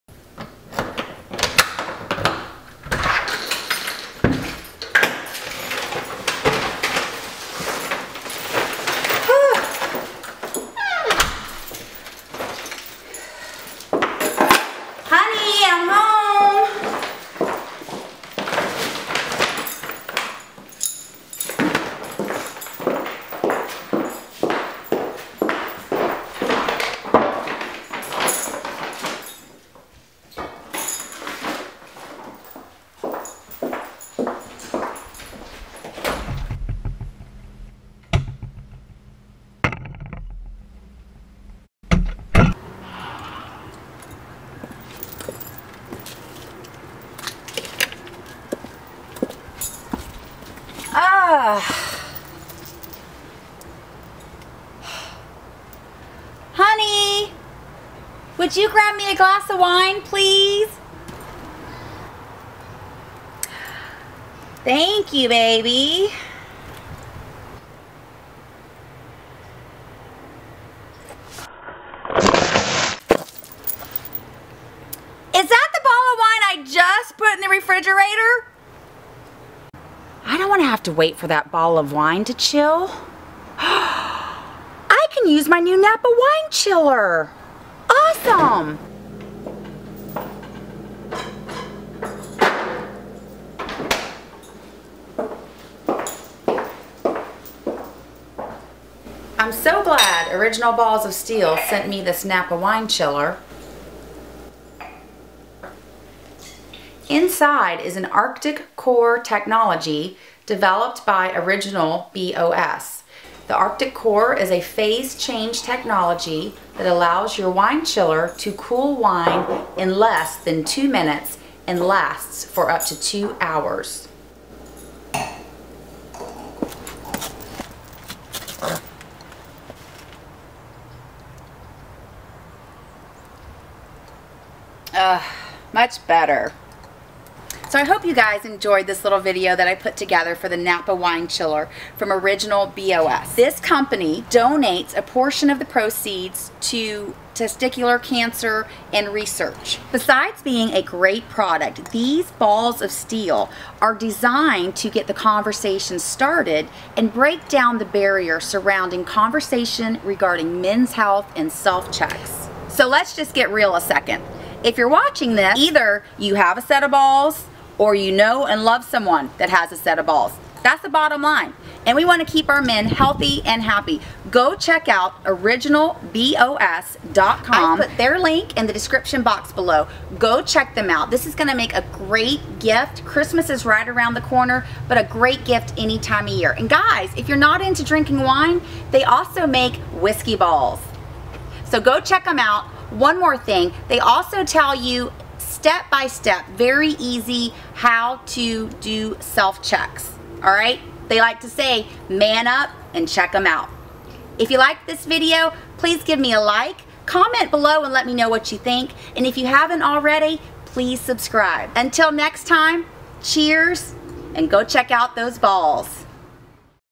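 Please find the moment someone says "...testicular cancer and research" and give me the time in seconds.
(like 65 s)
147 s.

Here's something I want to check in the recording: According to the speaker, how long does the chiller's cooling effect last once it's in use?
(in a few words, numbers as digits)
up to 2 hours.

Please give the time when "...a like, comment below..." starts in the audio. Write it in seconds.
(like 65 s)
206 s.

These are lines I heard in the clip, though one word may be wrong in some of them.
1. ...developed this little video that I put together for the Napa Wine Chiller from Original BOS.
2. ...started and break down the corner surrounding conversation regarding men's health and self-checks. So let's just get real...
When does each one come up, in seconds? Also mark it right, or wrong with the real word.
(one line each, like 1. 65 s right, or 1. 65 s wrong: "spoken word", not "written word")
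1. 138 s wrong: "enjoyed", not "developed"
2. 155 s wrong: "barrier", not "corner".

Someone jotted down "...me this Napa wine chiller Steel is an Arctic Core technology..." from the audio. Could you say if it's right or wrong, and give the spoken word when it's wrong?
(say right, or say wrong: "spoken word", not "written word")
wrong: "Inside", not "Steel".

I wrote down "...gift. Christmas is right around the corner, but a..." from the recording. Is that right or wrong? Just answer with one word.
right.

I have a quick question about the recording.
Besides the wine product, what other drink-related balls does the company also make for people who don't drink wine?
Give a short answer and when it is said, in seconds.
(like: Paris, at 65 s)
whiskey balls, at 189 s.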